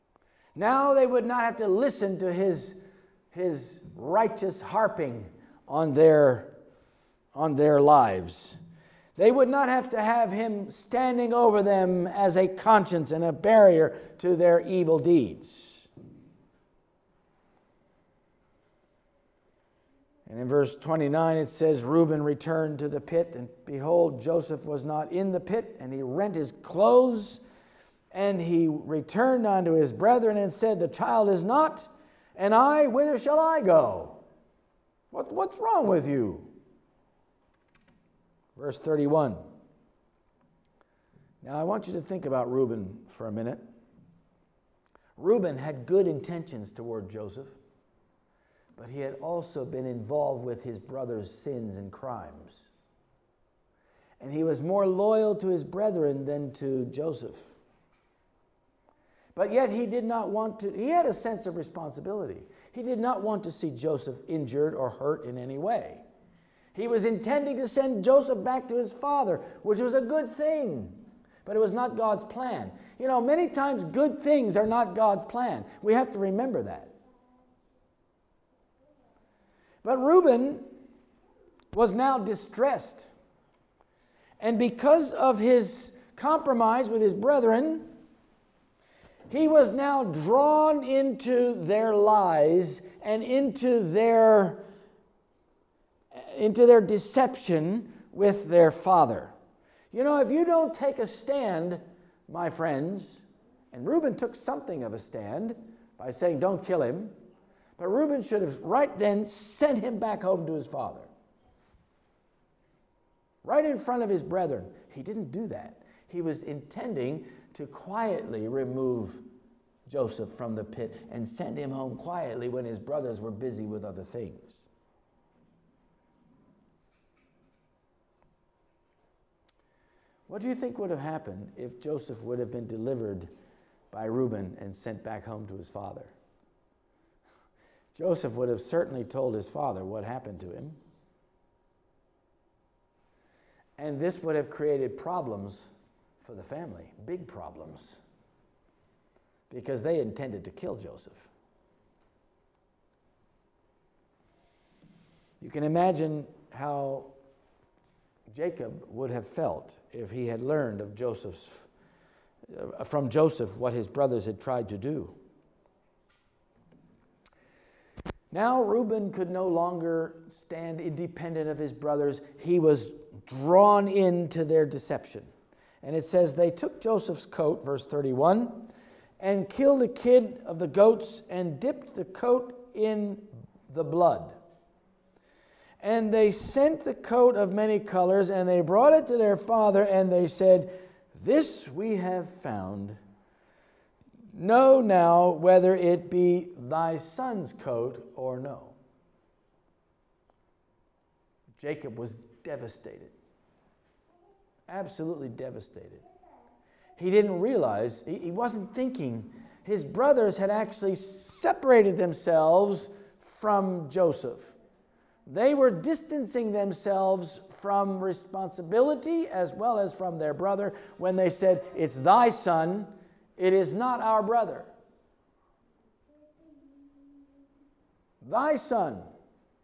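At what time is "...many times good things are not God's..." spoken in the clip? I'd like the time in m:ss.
1:13.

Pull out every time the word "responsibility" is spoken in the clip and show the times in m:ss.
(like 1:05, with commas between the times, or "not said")
1:01, 3:38.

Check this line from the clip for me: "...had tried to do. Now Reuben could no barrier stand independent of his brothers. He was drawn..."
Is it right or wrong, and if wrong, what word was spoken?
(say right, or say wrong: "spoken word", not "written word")
wrong: "longer", not "barrier".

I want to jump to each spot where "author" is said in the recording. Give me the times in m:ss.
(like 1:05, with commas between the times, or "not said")
not said.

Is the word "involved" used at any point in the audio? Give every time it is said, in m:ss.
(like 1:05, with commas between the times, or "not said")
0:49.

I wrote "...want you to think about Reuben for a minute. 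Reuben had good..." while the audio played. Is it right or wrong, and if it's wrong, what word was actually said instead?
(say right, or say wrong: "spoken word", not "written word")
right.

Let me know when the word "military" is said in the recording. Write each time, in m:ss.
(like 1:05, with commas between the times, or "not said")
not said.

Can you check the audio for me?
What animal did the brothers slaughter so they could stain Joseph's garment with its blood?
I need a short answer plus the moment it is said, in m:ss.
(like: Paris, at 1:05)
a kid of the goats, at 2:59.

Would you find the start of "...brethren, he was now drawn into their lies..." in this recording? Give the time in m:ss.
1:27.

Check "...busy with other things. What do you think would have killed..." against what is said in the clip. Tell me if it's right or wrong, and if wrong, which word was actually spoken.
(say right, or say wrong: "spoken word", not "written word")
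wrong: "happened", not "killed".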